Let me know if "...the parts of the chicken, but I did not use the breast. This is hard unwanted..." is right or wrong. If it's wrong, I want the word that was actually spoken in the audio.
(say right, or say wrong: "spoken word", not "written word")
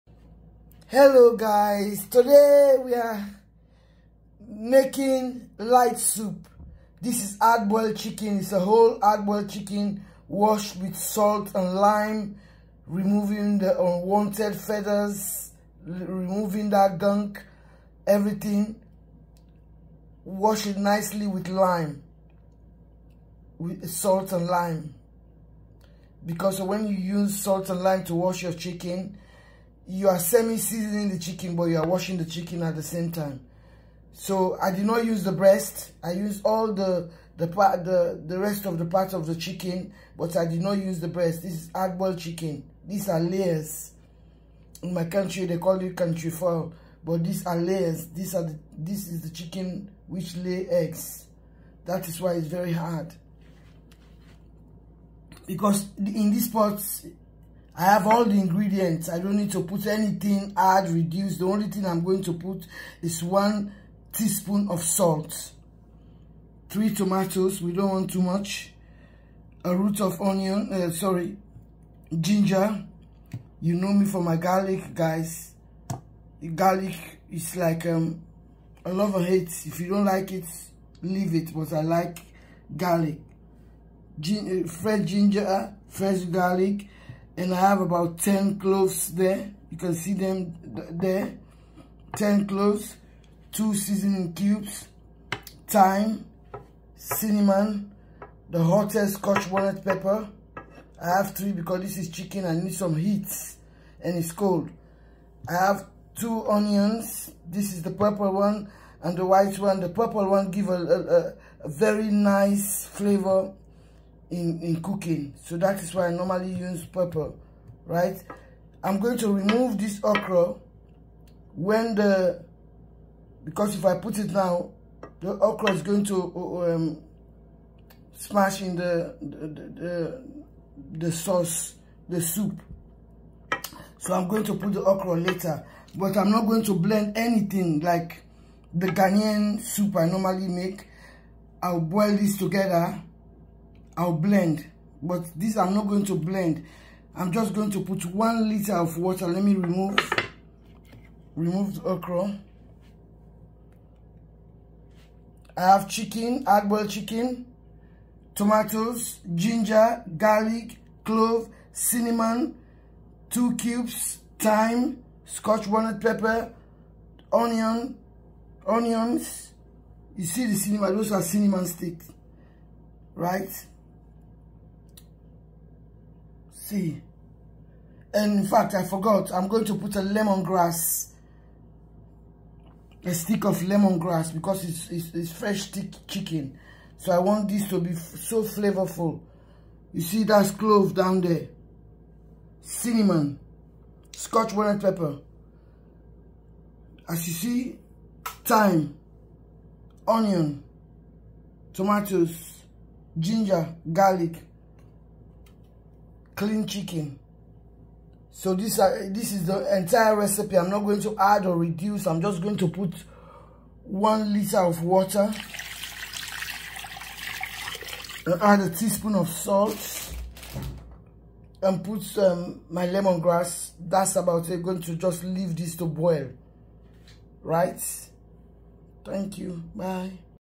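wrong: "boiled", not "unwanted".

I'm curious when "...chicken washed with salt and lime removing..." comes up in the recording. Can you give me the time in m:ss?
0:09.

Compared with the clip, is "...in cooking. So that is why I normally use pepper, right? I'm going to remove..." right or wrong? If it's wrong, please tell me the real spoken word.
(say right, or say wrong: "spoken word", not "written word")
right.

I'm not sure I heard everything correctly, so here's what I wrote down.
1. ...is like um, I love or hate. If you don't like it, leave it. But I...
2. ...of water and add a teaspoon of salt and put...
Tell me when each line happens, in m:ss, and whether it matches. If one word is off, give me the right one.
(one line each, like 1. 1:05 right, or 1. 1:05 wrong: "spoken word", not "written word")
1. 1:17 right
2. 3:34 right.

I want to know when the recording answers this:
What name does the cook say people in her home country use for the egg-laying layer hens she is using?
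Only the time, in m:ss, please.
0:45.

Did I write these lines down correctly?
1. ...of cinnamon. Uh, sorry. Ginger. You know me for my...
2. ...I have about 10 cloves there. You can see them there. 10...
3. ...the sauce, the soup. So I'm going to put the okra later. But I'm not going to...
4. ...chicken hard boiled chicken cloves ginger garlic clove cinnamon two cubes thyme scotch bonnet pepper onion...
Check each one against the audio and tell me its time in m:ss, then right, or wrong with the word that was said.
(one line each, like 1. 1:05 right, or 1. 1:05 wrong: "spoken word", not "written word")
1. 1:10 wrong: "onion", not "cinnamon"
2. 1:27 right
3. 2:11 right
4. 2:35 wrong: "tomatoes", not "cloves".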